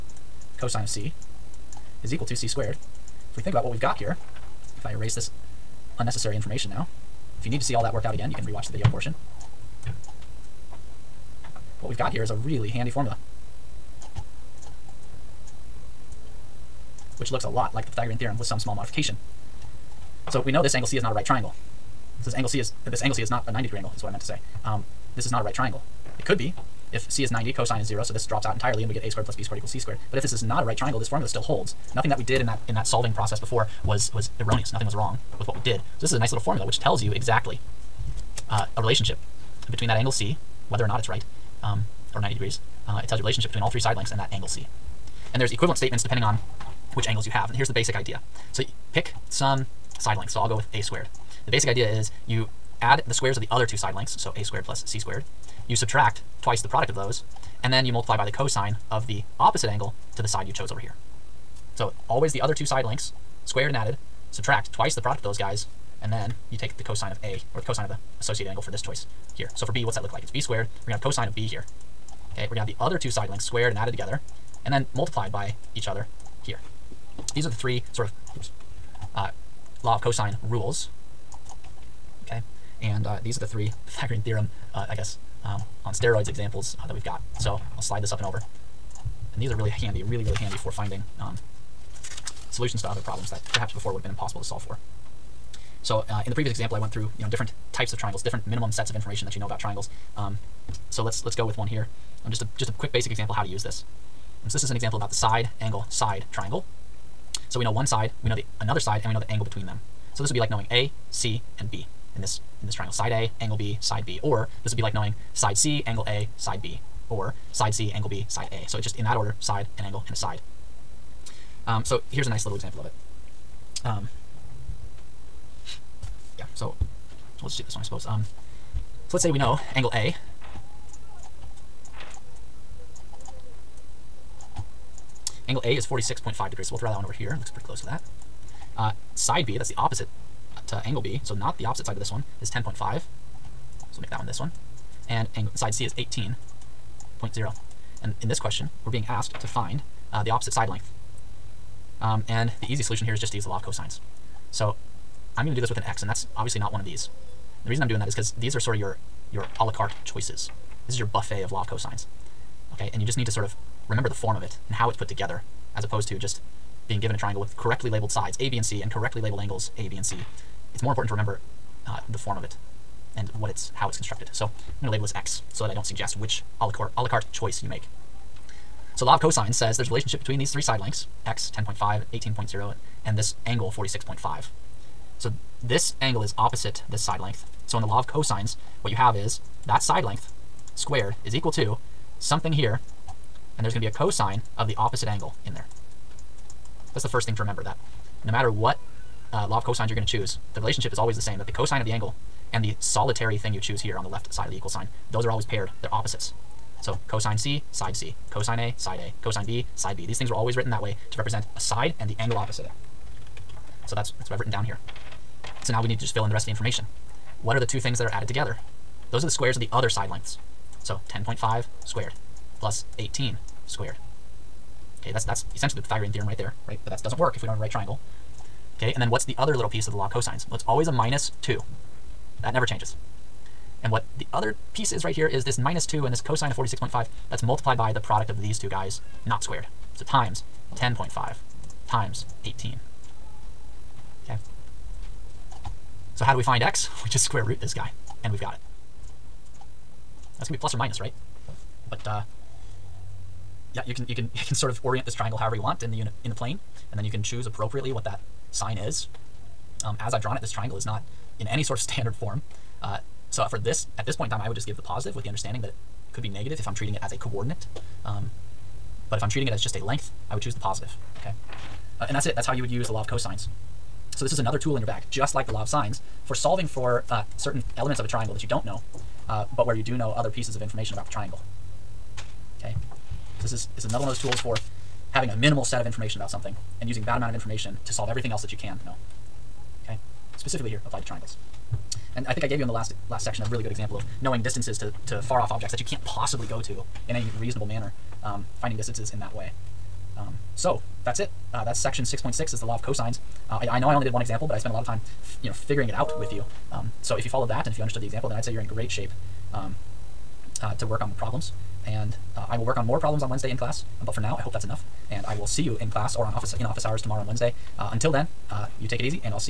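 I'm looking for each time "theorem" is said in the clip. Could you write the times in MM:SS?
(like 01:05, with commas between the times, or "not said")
00:18, 01:24, 03:46.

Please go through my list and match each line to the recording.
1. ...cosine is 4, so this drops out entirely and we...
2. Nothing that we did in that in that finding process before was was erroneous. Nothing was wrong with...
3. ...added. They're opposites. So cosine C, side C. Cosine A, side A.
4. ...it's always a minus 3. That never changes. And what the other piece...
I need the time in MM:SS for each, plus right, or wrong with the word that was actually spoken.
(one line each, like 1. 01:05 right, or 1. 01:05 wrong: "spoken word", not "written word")
1. 00:27 wrong: "0", not "4"
2. 00:31 wrong: "solving", not "finding"
3. 03:25 wrong: "paired", not "added"
4. 03:50 wrong: "2", not "3".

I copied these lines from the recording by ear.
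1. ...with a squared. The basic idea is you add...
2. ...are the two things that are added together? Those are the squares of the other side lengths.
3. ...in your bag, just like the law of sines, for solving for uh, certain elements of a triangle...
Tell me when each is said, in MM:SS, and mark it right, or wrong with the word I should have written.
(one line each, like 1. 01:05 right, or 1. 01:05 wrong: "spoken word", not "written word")
1. 00:50 right
2. 03:37 right
3. 04:34 right.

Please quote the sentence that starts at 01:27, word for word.
So I'll slide this up and over.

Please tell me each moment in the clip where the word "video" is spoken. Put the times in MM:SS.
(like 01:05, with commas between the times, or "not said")
00:08.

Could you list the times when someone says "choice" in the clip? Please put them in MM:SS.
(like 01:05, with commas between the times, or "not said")
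01:08, 02:40, 02:57.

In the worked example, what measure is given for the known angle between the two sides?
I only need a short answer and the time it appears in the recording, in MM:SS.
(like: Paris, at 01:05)
46.5 degrees, at 02:15.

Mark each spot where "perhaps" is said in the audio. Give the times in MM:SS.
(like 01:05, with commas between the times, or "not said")
01:33.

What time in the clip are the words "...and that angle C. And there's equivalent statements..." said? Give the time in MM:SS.
00:44.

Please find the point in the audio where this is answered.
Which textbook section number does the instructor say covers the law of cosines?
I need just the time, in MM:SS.
05:01.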